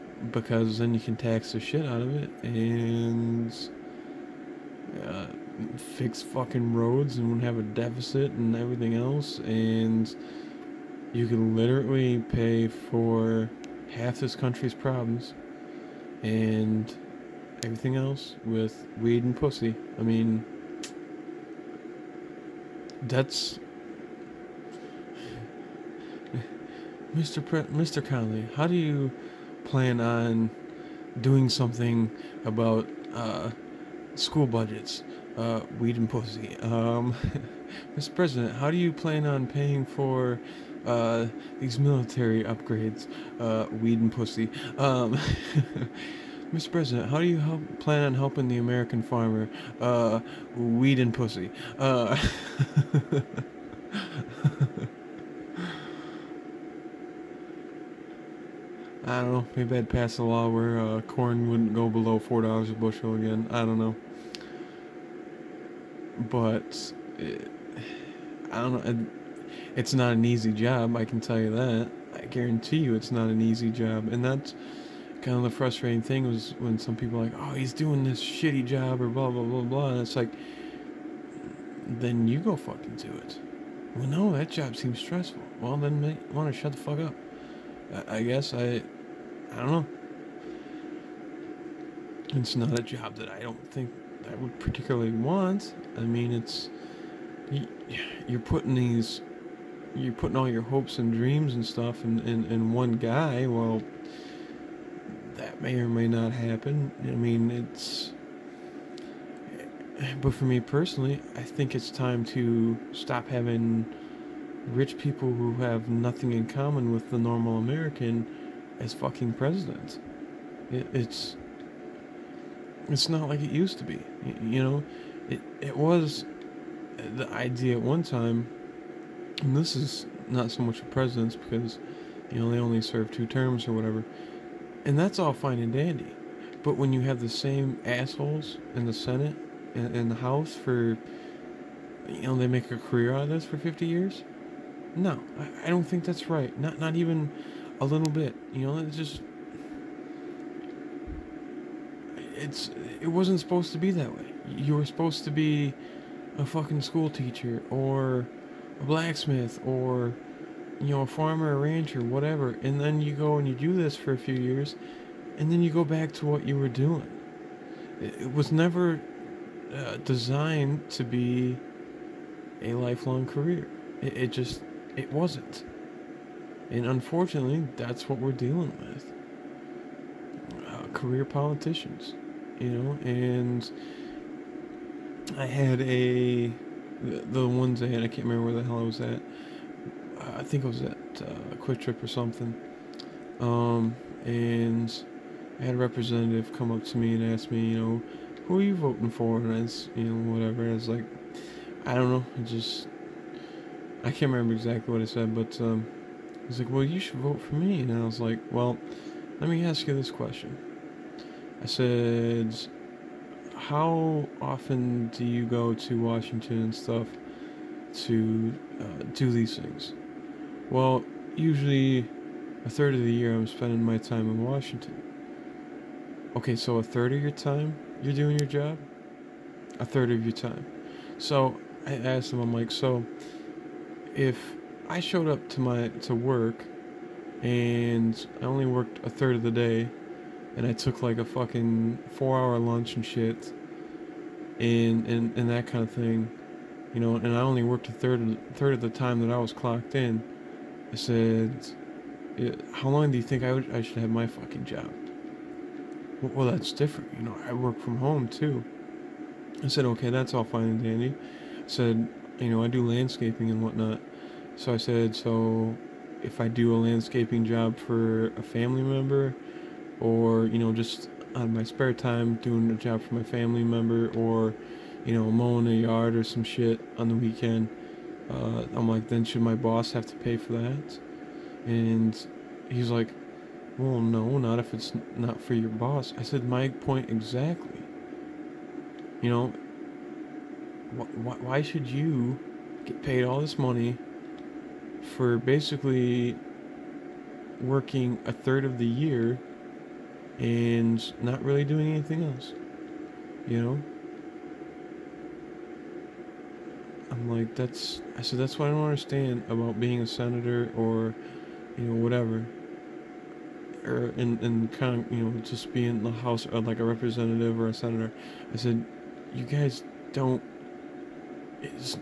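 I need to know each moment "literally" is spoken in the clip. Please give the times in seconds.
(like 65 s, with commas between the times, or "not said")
11 s.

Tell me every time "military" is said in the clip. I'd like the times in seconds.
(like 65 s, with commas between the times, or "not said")
41 s.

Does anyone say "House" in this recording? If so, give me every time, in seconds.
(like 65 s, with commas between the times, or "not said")
140 s, 316 s.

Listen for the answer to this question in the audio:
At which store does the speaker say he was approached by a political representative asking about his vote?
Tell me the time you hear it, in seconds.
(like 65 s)
191 s.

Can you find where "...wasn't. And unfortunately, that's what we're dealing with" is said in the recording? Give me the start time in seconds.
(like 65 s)
175 s.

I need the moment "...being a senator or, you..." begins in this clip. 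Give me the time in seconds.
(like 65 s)
309 s.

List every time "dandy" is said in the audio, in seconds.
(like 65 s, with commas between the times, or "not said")
135 s, 260 s.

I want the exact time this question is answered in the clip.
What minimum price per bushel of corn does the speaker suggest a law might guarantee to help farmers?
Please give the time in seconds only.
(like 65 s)
62 s.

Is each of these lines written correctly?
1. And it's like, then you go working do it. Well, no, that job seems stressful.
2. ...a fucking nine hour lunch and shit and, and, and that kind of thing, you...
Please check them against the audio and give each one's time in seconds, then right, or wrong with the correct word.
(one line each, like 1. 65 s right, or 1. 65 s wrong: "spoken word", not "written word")
1. 79 s wrong: "fucking", not "working"
2. 241 s wrong: "four", not "nine".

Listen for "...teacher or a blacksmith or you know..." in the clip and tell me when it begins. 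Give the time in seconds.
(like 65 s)
157 s.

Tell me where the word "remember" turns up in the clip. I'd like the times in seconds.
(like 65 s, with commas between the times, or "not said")
188 s, 204 s.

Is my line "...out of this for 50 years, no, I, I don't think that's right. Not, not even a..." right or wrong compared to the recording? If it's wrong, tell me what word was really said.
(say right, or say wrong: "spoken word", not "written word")
right.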